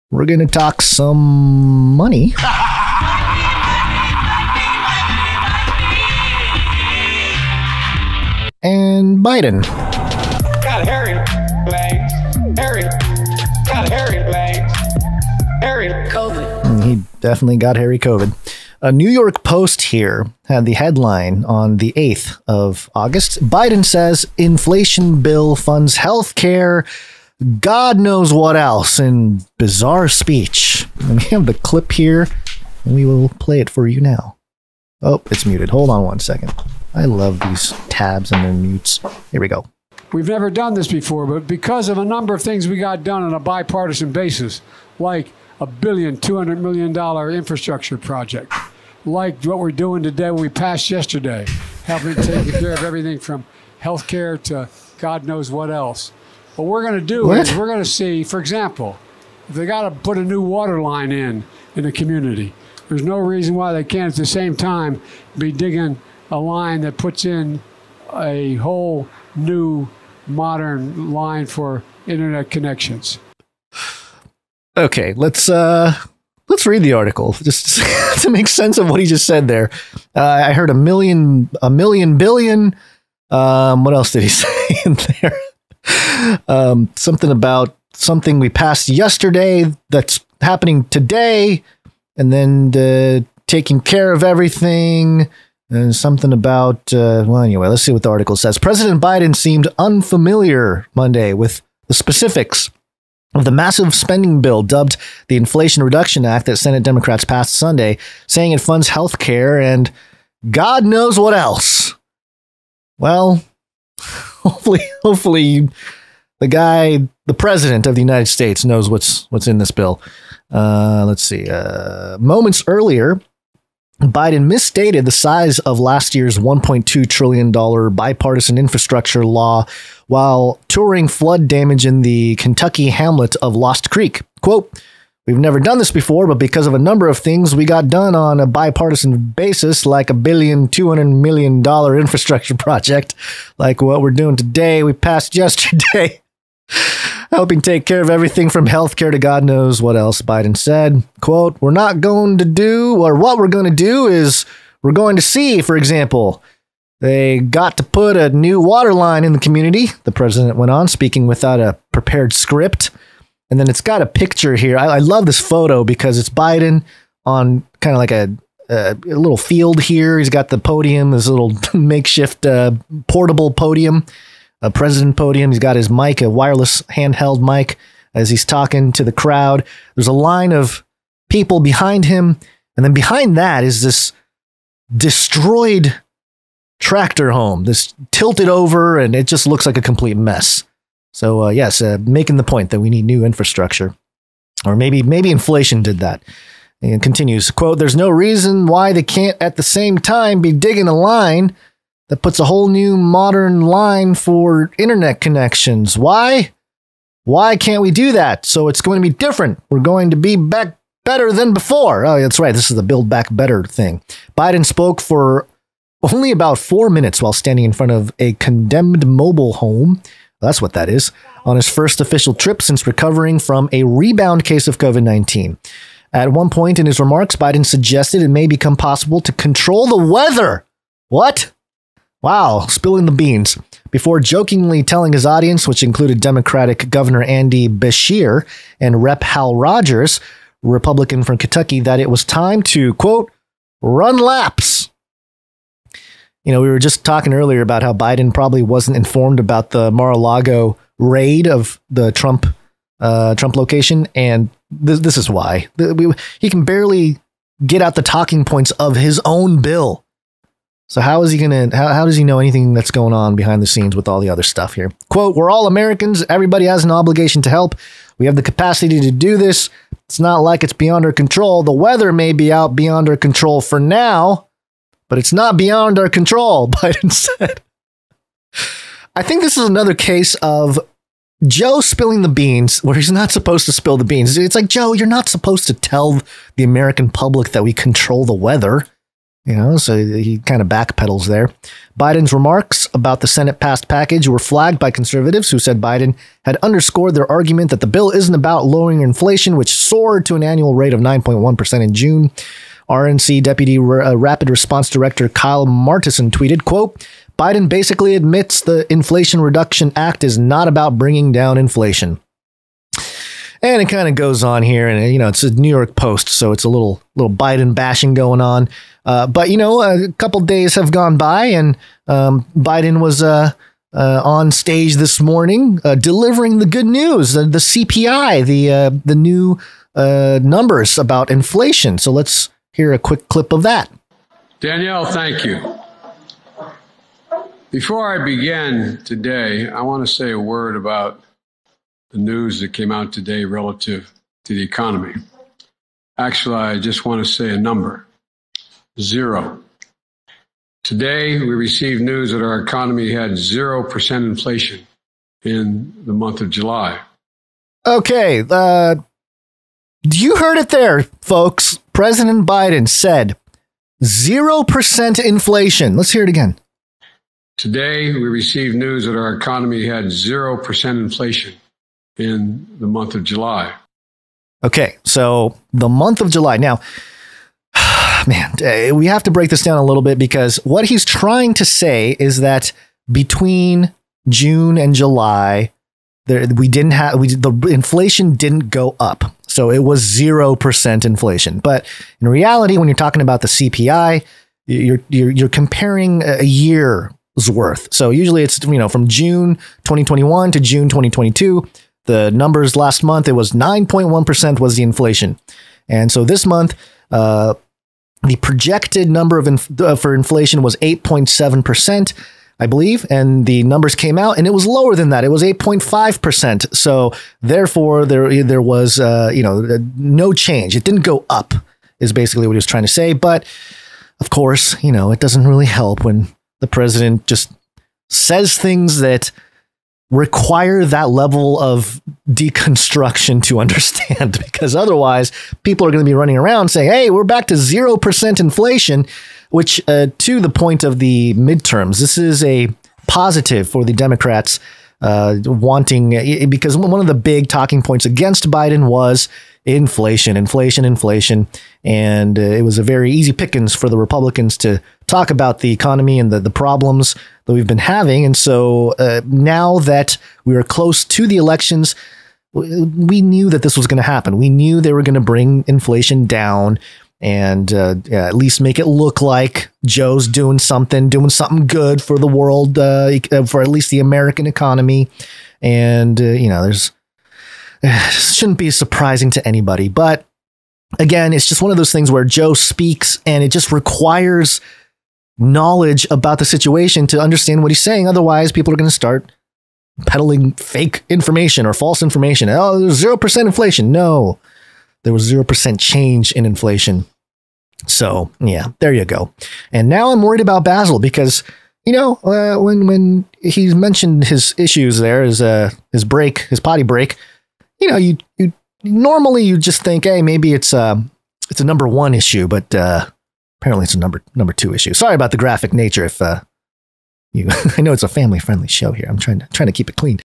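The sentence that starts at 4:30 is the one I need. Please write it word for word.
It's not like it's beyond our control.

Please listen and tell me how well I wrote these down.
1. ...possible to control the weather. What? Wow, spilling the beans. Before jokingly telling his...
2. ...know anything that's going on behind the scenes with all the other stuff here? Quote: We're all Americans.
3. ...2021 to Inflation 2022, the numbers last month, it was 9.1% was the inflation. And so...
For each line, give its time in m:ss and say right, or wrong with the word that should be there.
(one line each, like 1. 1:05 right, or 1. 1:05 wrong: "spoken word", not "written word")
1. 3:48 right
2. 4:22 right
3. 6:39 wrong: "June", not "Inflation".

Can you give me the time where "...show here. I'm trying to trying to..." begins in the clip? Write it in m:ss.
8:38.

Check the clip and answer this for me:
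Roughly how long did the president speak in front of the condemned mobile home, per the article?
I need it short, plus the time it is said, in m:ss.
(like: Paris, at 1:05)
About four minutes, at 3:36.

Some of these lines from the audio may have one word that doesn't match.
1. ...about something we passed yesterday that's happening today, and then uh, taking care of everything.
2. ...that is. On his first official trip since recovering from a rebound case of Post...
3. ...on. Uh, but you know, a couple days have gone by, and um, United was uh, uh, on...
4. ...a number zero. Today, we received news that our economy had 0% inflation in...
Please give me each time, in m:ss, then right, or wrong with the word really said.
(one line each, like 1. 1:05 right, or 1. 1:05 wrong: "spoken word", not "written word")
1. 1:27 right
2. 3:40 wrong: "COVID", not "Post"
3. 5:18 wrong: "Biden", not "United"
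4. 5:47 right.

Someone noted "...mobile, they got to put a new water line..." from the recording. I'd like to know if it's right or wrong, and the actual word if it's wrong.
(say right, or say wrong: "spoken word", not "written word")
wrong: "example", not "mobile".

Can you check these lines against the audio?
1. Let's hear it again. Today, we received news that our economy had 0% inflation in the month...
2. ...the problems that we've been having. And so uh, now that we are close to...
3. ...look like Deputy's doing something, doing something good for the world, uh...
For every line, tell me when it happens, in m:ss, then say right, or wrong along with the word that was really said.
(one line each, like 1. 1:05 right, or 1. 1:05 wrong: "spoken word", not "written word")
1. 6:05 right
2. 7:36 right
3. 7:48 wrong: "Joe", not "Deputy".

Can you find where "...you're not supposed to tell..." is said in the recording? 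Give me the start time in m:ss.
4:44.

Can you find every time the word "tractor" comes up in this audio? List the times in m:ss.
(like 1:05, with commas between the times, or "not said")
3:06.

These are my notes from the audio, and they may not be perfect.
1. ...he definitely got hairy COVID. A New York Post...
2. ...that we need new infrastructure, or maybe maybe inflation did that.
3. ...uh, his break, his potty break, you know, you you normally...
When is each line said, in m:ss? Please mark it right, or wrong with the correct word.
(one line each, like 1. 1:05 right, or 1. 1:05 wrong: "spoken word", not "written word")
1. 0:16 right
2. 3:12 right
3. 8:25 right.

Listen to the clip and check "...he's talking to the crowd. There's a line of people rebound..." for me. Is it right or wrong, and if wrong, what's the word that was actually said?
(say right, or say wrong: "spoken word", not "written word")
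wrong: "behind", not "rebound".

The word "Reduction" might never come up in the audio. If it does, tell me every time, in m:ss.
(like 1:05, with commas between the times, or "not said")
1:45, 5:09.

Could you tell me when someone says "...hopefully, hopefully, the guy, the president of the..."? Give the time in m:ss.
1:54.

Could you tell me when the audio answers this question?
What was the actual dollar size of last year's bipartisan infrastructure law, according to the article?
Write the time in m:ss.
2:06.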